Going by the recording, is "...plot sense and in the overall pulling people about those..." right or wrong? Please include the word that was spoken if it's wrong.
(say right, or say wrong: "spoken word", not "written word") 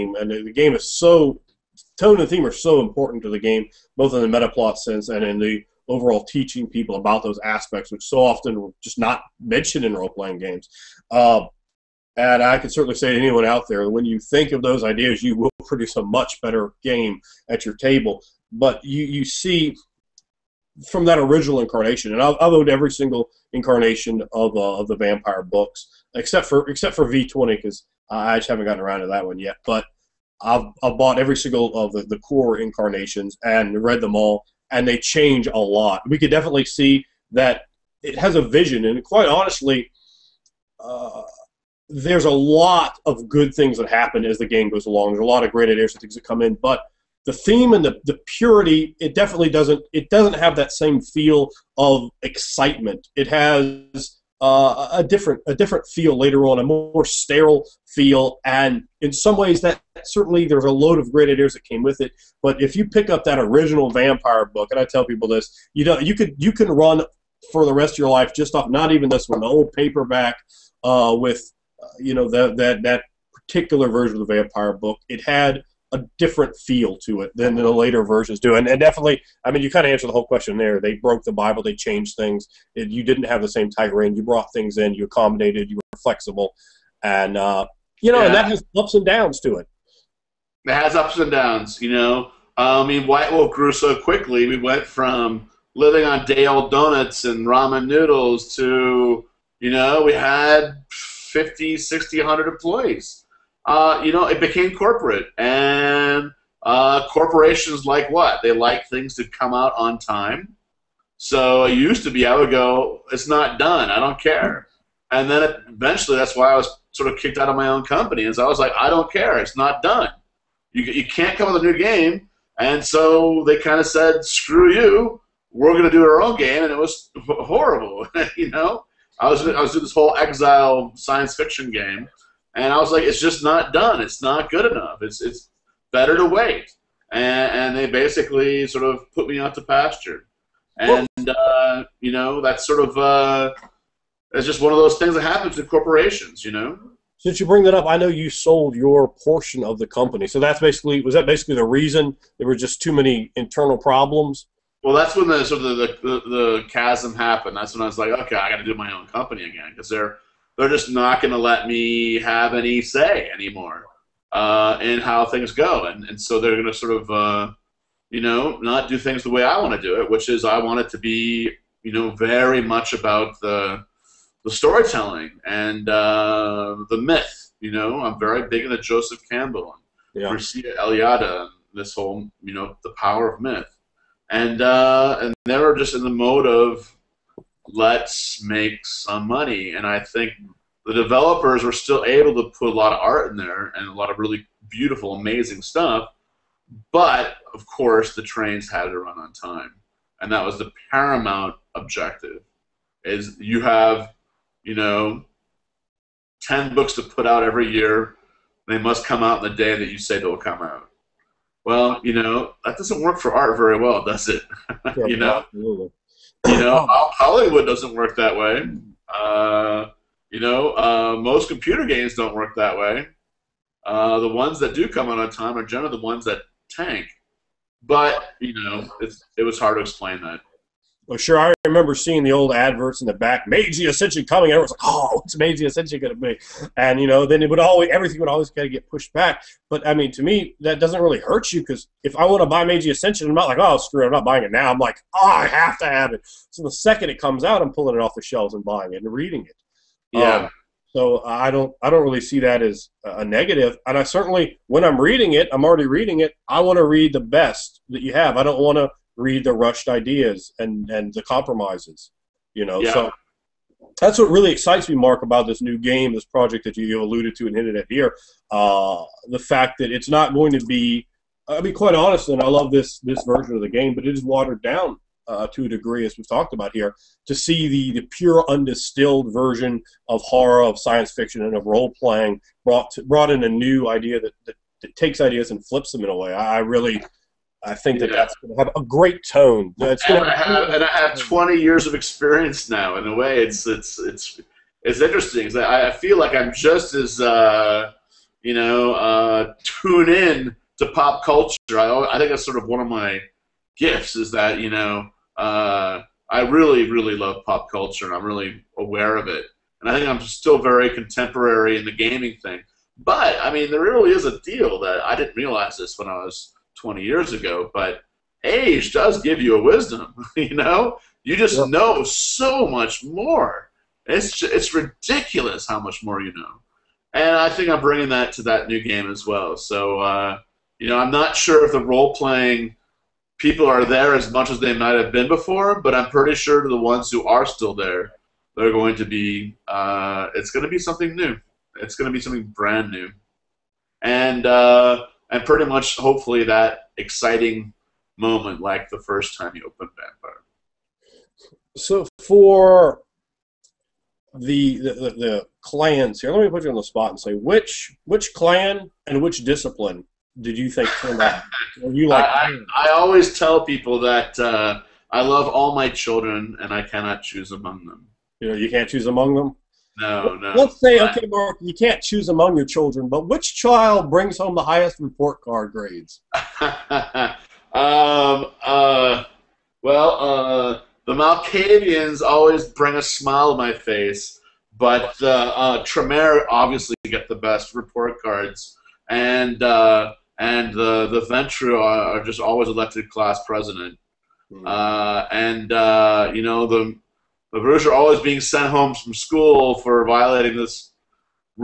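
wrong: "teaching", not "pulling".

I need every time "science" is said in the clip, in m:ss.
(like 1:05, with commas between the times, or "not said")
2:10, 4:40.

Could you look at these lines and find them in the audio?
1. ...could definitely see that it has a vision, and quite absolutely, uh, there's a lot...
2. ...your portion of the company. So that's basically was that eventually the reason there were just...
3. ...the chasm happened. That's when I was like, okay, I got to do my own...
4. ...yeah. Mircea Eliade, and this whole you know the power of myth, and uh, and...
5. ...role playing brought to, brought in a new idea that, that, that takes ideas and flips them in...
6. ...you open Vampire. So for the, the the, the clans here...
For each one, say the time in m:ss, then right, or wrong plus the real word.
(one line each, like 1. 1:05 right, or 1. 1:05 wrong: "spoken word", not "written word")
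1. 0:36 wrong: "honestly", not "absolutely"
2. 2:28 wrong: "basically", not "eventually"
3. 2:36 right
4. 3:00 right
5. 4:41 right
6. 5:49 right.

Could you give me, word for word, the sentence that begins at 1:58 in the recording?
Is I was like, I don't care, it's not done.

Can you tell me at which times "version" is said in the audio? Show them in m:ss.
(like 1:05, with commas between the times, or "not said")
1:13, 1:18, 4:33, 4:39.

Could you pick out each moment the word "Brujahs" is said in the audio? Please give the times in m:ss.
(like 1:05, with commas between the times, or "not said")
6:37.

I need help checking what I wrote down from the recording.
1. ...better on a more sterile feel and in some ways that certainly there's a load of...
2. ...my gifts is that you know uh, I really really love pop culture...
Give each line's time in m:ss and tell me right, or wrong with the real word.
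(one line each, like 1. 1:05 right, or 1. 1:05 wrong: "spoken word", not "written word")
1. 0:56 wrong: "later", not "better"
2. 5:02 right.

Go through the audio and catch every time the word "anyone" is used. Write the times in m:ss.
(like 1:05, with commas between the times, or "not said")
0:13.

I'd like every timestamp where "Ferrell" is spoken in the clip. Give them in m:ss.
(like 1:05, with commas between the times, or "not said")
not said.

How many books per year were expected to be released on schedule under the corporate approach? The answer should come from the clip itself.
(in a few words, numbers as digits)
10.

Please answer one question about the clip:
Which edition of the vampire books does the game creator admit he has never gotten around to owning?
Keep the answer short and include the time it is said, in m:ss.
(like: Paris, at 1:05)
V20, at 0:27.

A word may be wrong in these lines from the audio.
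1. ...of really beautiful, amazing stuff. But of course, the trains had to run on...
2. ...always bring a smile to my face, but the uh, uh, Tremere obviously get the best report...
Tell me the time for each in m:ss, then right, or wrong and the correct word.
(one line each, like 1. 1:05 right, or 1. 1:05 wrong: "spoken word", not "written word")
1. 3:14 right
2. 6:22 right.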